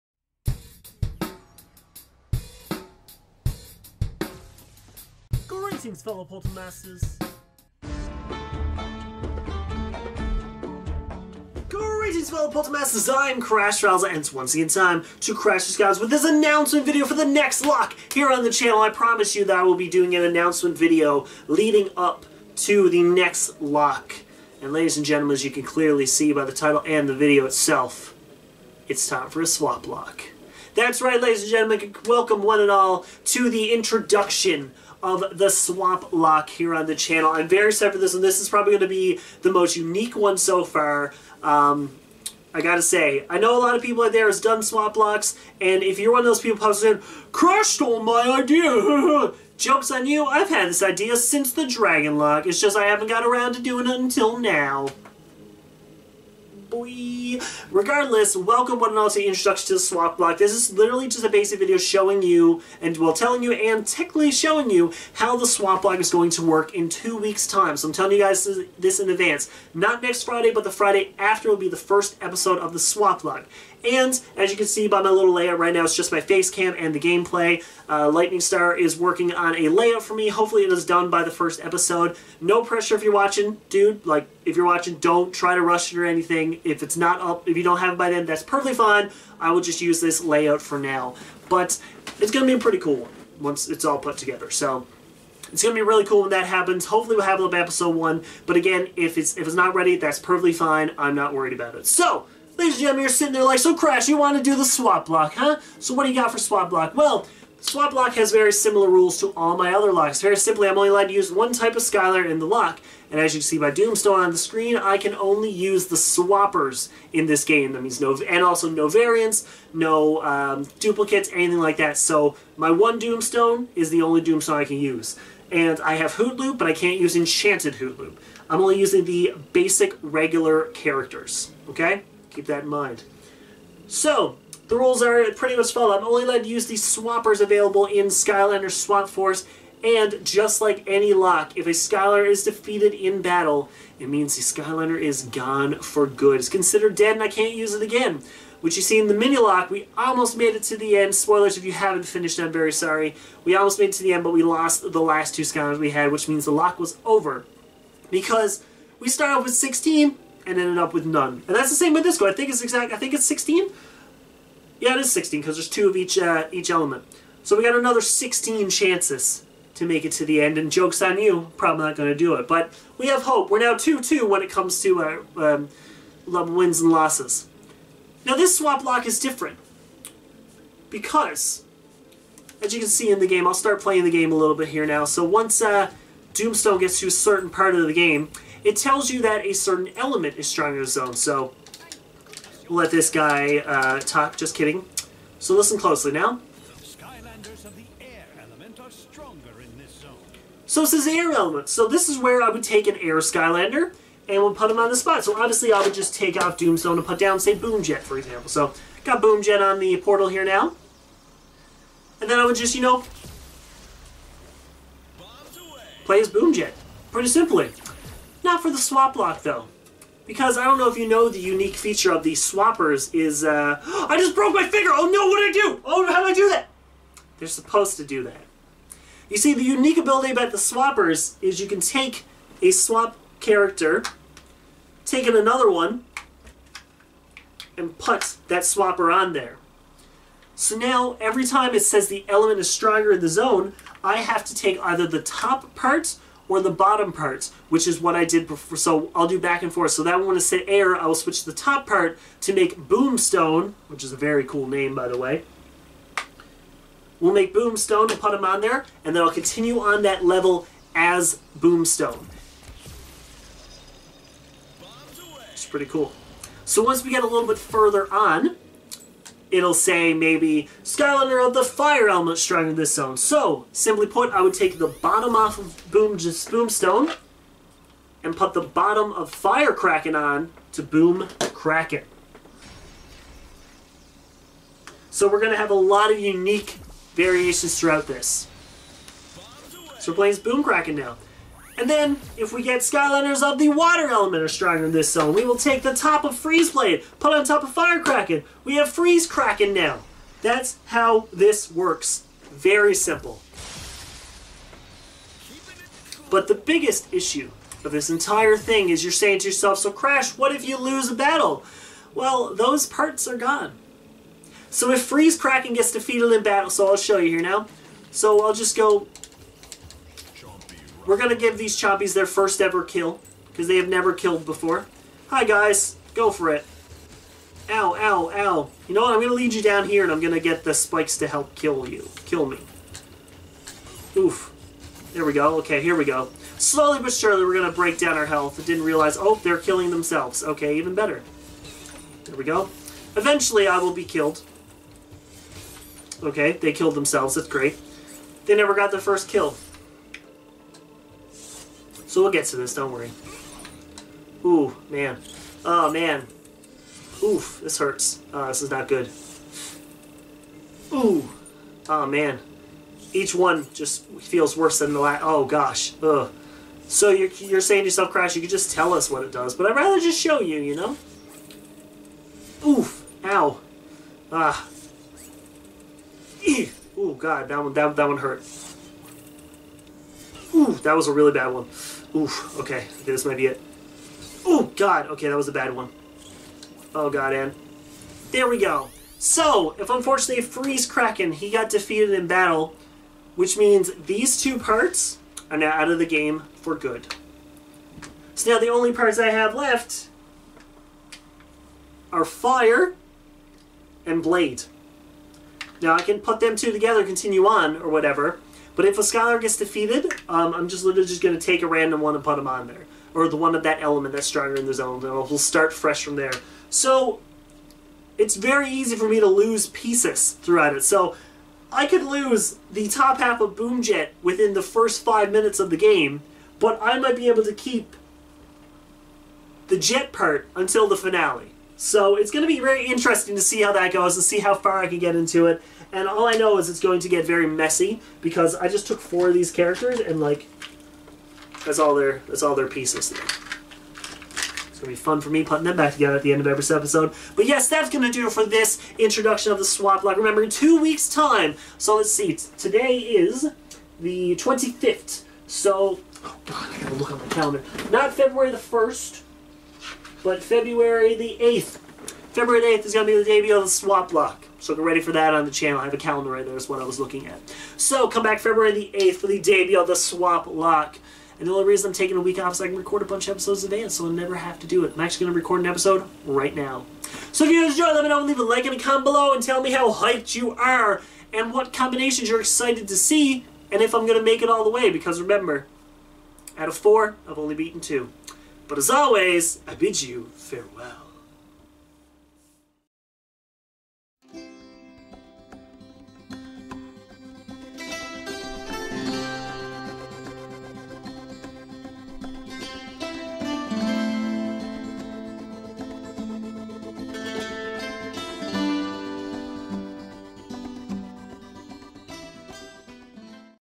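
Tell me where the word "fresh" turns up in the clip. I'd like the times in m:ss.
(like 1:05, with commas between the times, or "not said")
6:55.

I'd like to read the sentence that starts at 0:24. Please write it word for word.
And ladies and gentlemen, as you can clearly see by the title and the video itself, it's time for a swap lock.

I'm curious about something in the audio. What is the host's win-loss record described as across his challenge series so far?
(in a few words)
2-2.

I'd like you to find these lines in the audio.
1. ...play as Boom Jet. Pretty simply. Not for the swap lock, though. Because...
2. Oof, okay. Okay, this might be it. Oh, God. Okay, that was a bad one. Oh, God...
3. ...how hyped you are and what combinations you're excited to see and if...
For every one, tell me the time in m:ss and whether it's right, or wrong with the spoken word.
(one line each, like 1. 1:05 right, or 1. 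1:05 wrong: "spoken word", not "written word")
1. 3:36 right
2. 6:22 right
3. 7:59 right.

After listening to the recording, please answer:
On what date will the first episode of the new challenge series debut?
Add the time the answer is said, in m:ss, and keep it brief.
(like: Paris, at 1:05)
February 8th, at 7:42.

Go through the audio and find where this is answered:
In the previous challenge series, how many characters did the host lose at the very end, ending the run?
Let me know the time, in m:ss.
2:35.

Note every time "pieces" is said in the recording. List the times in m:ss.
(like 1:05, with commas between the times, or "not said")
6:59, 7:22.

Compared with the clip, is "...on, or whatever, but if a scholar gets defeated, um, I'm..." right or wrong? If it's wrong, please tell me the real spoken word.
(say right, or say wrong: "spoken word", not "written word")
right.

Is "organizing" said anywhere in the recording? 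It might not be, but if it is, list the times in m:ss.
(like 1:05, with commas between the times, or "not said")
not said.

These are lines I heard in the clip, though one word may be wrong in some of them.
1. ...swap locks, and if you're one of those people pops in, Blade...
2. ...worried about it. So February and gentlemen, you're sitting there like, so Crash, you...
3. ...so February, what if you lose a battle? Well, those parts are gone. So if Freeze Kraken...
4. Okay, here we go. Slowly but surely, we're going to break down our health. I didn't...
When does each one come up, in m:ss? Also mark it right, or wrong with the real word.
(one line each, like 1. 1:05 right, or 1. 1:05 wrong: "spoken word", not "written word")
1. 0:44 wrong: "Crash", not "Blade"
2. 1:41 wrong: "Ladies", not "February"
3. 5:09 wrong: "Crash", not "February"
4. 5:35 right.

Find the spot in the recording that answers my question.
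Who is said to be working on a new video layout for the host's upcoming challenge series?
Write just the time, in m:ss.
1:18.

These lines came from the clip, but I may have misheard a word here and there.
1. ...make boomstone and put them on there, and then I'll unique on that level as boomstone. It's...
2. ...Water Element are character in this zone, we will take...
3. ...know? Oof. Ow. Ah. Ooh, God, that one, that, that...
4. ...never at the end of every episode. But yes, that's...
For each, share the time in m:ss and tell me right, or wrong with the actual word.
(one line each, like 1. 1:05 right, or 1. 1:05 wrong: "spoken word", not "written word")
1. 4:17 wrong: "continue", not "unique"
2. 4:53 wrong: "stronger", not "character"
3. 6:10 right
4. 7:25 wrong: "together", not "never".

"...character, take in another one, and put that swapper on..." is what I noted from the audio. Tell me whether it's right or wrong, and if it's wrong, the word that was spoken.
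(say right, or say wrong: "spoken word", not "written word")
right.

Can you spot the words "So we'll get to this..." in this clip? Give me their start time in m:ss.
5:52.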